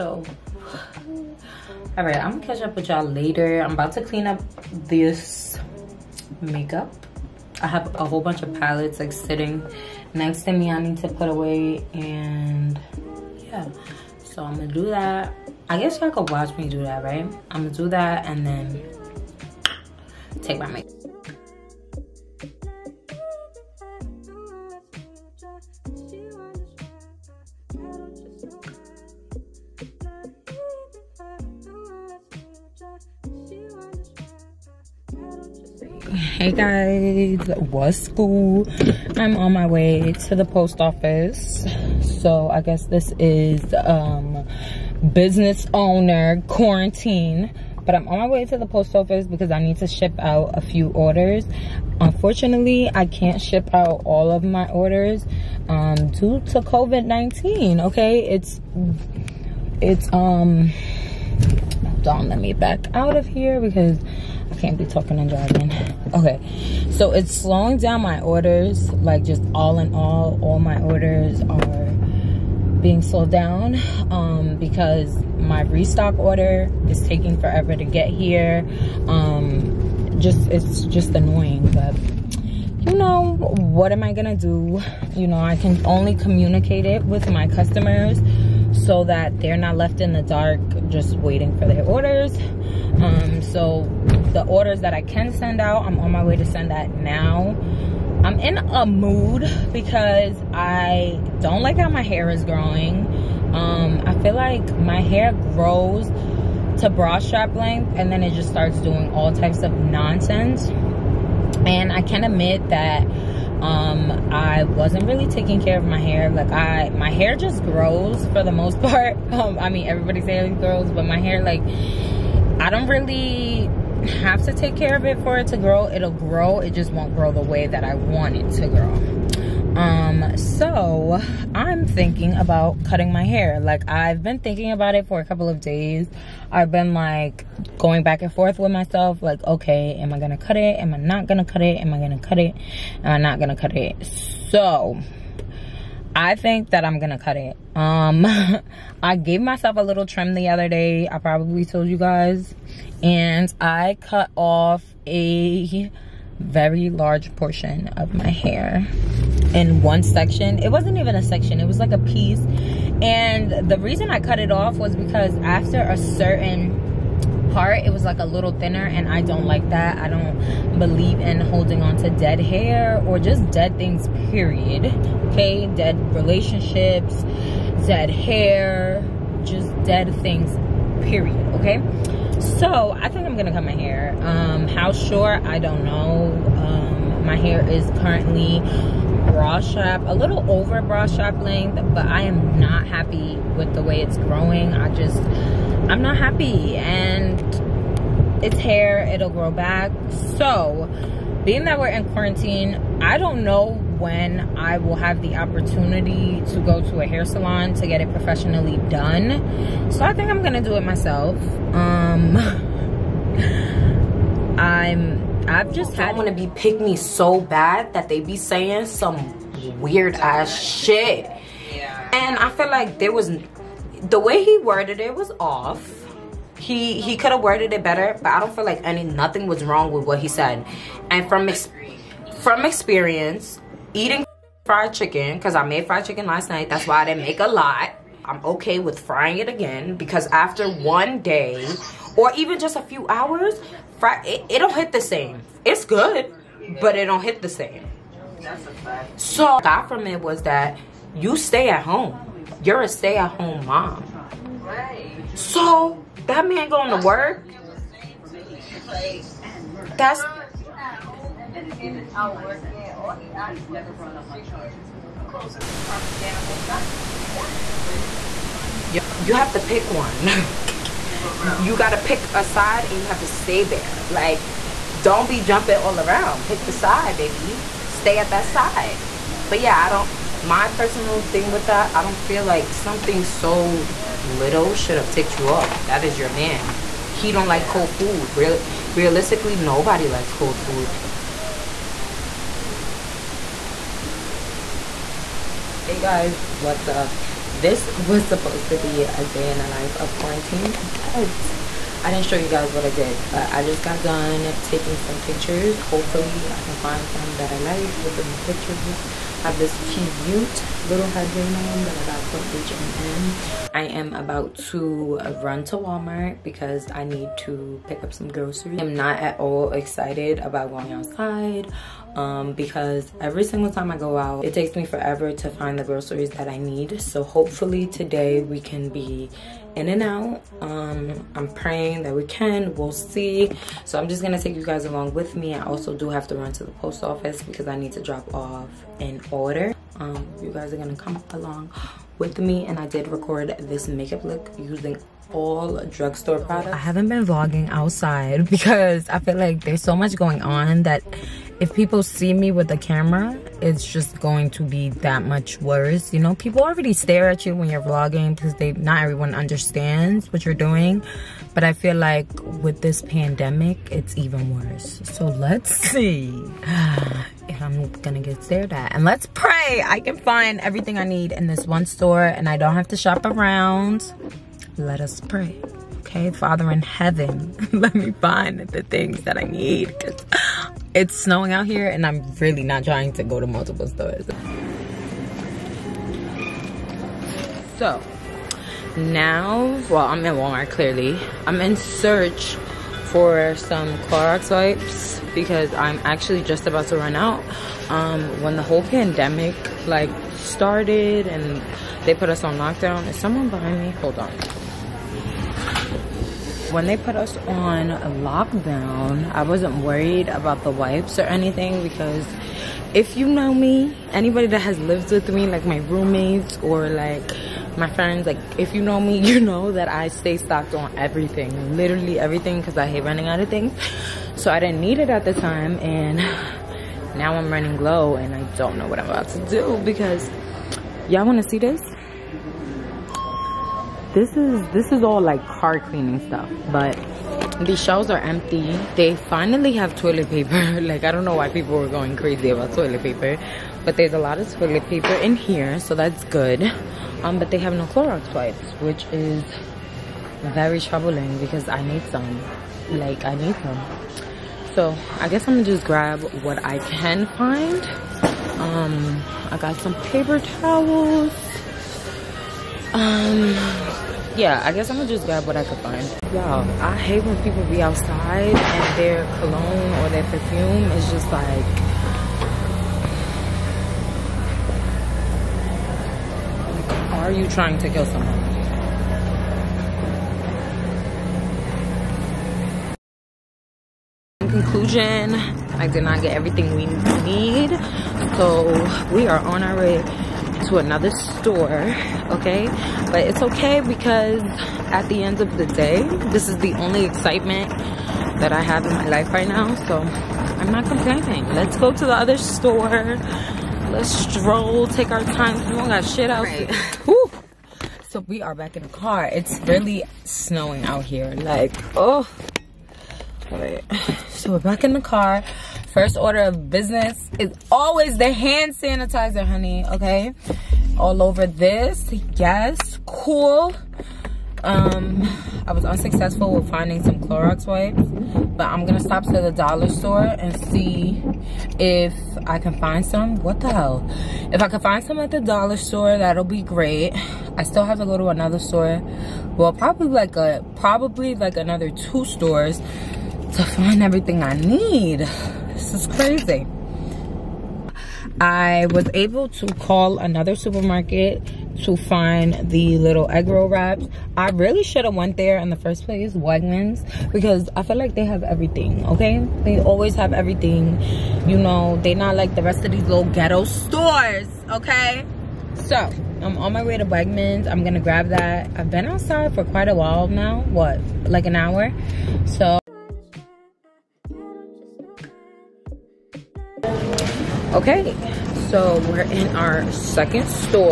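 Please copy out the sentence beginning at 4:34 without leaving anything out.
Like, don't be jumping all around.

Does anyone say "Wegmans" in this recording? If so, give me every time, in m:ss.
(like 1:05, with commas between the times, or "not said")
9:16, 9:27.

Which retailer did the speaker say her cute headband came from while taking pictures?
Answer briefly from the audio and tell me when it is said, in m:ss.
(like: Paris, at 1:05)
H&M, at 5:12.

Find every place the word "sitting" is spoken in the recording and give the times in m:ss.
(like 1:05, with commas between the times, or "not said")
0:09.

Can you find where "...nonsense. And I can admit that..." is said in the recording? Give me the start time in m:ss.
1:49.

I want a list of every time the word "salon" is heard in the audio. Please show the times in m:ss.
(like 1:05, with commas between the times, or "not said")
3:27.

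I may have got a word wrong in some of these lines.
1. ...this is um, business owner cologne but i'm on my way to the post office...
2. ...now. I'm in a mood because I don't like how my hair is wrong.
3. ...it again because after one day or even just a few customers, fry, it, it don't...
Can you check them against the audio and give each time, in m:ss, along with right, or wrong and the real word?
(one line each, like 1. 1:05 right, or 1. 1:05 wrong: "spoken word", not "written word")
1. 0:42 wrong: "quarantine", not "cologne"
2. 1:36 wrong: "growing", not "wrong"
3. 3:59 wrong: "hours", not "customers".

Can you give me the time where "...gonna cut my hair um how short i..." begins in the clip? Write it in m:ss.
3:03.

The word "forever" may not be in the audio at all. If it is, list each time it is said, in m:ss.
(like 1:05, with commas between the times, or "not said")
1:17, 5:24.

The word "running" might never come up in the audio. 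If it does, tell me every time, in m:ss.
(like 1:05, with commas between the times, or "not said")
7:03, 7:07.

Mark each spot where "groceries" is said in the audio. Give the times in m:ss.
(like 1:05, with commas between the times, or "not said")
5:18, 5:25.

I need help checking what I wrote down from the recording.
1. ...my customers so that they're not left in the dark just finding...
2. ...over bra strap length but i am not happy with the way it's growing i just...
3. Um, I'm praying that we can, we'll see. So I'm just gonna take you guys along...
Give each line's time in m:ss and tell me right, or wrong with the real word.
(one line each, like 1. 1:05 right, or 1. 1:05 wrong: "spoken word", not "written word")
1. 1:27 wrong: "waiting", not "finding"
2. 3:10 right
3. 5:30 right.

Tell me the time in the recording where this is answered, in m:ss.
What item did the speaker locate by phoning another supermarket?
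9:13.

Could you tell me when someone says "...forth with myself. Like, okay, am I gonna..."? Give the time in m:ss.
2:18.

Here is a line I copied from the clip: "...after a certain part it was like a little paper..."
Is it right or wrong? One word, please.
wrong.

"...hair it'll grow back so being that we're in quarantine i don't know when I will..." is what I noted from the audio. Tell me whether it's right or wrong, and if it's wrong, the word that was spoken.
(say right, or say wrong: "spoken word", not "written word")
right.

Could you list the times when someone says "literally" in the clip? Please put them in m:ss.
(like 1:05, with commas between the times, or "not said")
7:01.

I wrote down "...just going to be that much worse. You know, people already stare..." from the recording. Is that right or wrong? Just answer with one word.
right.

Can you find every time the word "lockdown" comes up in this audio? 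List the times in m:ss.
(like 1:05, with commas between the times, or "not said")
6:42, 6:48.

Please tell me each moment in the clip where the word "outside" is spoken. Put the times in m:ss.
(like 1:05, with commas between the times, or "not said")
5:20, 5:47, 7:47, 9:29.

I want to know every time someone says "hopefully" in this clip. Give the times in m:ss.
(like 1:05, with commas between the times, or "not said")
5:05, 5:27.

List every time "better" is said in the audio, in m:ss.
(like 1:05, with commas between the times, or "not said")
3:47.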